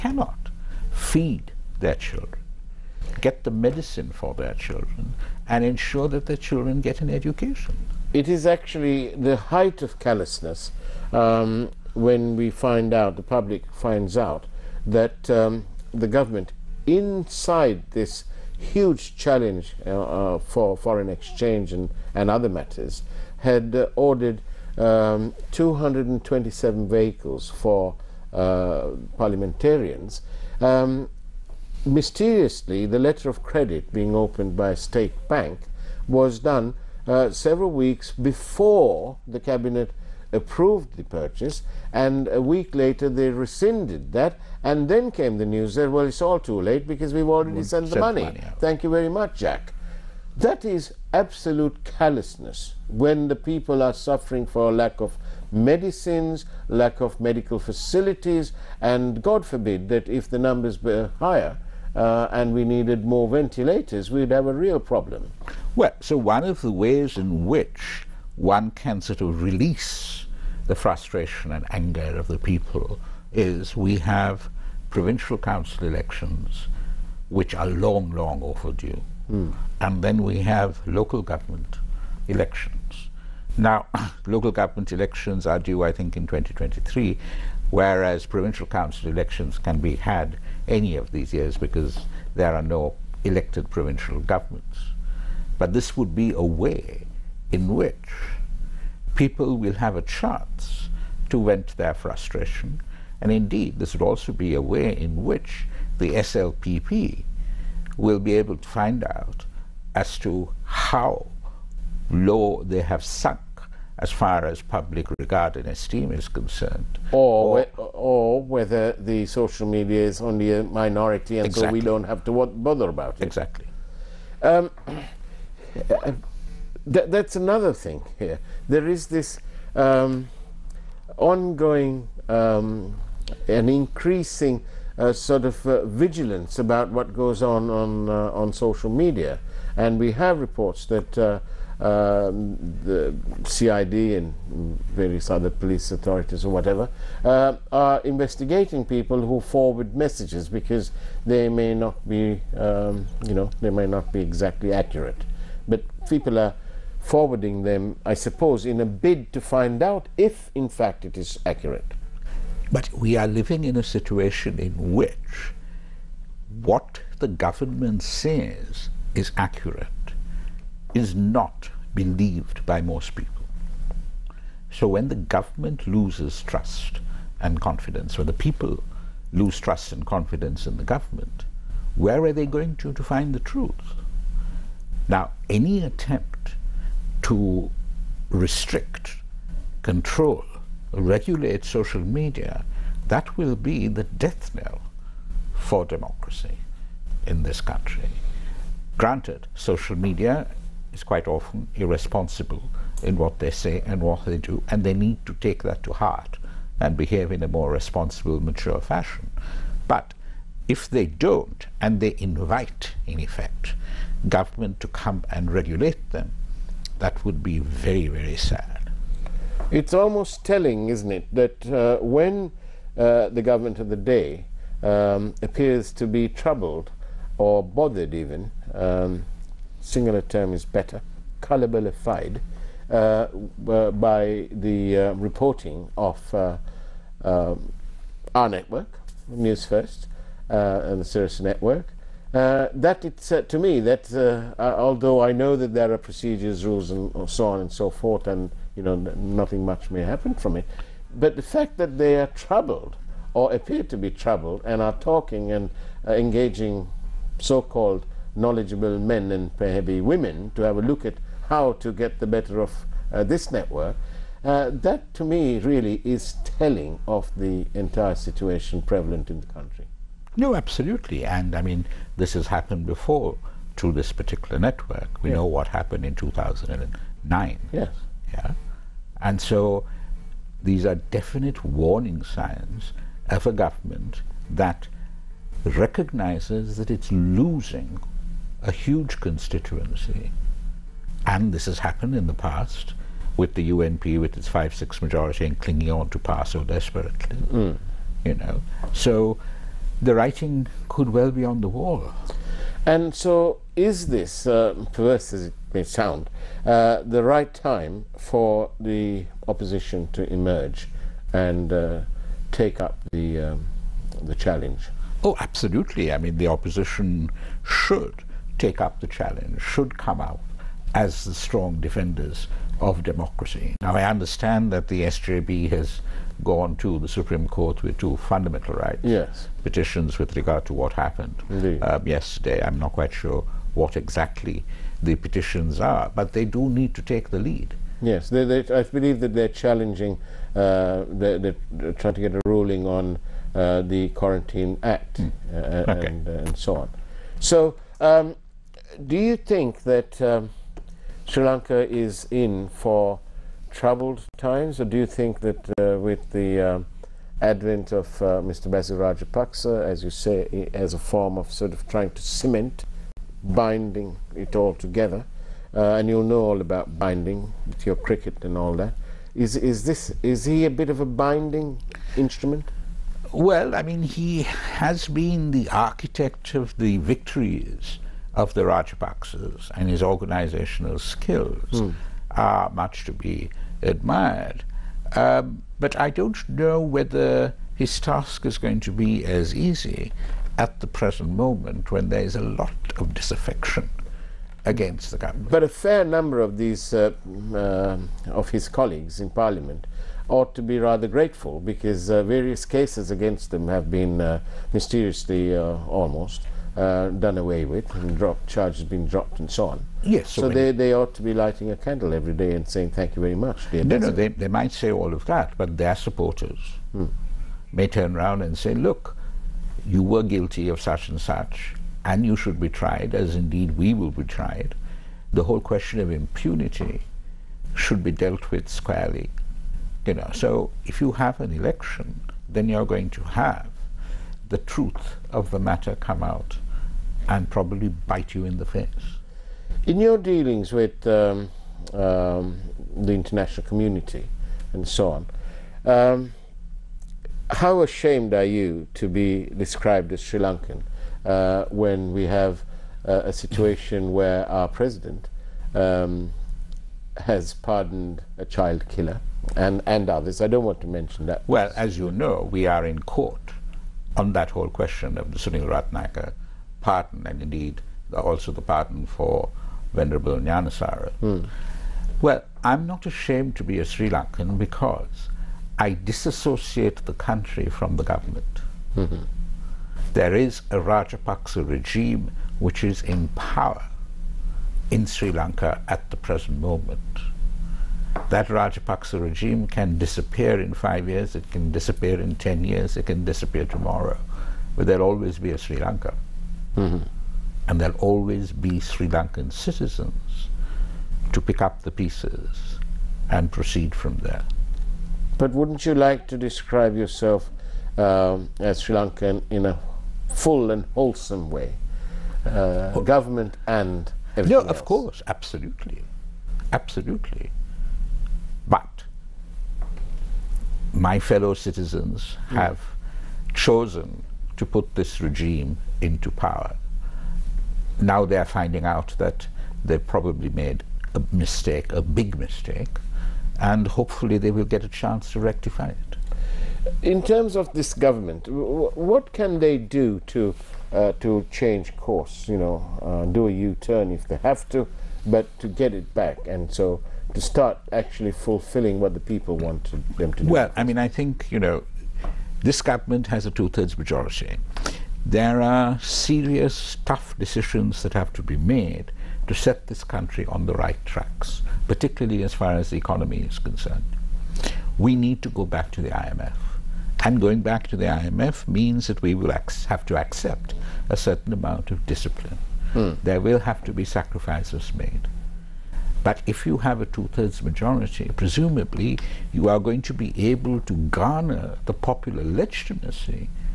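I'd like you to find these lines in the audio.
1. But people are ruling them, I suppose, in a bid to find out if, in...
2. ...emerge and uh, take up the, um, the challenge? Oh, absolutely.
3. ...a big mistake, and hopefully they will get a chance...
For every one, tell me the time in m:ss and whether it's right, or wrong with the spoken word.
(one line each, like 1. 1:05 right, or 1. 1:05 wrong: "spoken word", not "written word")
1. 2:35 wrong: "forwarding", not "ruling"
2. 5:10 right
3. 8:51 right.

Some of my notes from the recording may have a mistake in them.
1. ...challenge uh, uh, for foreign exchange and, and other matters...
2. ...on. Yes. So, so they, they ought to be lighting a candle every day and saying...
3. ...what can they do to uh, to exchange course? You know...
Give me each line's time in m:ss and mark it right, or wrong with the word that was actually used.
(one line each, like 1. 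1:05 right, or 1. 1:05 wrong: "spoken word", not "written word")
1. 0:19 right
2. 6:49 right
3. 8:58 wrong: "change", not "exchange".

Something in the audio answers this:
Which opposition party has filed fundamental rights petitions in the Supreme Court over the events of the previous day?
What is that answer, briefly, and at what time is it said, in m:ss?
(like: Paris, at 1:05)
SJB, at 5:25.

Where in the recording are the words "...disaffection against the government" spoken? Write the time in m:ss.
6:33.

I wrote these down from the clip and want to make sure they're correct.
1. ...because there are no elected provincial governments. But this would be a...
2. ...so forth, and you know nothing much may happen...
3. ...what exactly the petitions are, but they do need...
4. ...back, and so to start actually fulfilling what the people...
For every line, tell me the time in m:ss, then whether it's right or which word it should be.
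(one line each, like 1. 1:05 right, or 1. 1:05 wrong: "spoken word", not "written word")
1. 1:31 right
2. 4:07 right
3. 5:33 right
4. 9:06 right.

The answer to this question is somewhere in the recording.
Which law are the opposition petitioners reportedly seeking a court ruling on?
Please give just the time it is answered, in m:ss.
5:44.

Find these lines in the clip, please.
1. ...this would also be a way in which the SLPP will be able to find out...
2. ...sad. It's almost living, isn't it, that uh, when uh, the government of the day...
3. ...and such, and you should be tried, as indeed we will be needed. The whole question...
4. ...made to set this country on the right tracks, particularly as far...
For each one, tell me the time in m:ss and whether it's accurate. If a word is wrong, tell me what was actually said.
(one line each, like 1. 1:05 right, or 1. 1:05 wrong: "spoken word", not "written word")
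1. 1:43 right
2. 3:38 wrong: "telling", not "living"
3. 7:01 wrong: "tried", not "needed"
4. 9:18 right.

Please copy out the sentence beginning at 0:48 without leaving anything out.
money Thank you very much, Jack.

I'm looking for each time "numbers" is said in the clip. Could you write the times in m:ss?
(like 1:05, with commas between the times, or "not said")
1:00, 6:36.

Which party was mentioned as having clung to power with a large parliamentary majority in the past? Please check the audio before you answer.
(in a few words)
UNP.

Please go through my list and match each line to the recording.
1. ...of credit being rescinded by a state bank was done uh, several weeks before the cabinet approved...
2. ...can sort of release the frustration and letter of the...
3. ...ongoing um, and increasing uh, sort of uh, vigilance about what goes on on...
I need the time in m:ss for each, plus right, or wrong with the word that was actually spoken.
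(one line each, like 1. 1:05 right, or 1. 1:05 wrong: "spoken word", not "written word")
1. 0:33 wrong: "opened", not "rescinded"
2. 1:08 wrong: "anger", not "letter"
3. 2:11 right.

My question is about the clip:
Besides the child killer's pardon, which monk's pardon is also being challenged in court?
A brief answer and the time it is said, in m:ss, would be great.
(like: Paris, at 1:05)
Venerable Gnanasara, at 7:49.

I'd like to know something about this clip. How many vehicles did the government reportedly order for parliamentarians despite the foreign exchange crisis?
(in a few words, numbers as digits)
227.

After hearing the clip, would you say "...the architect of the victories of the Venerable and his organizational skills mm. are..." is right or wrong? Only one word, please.
wrong.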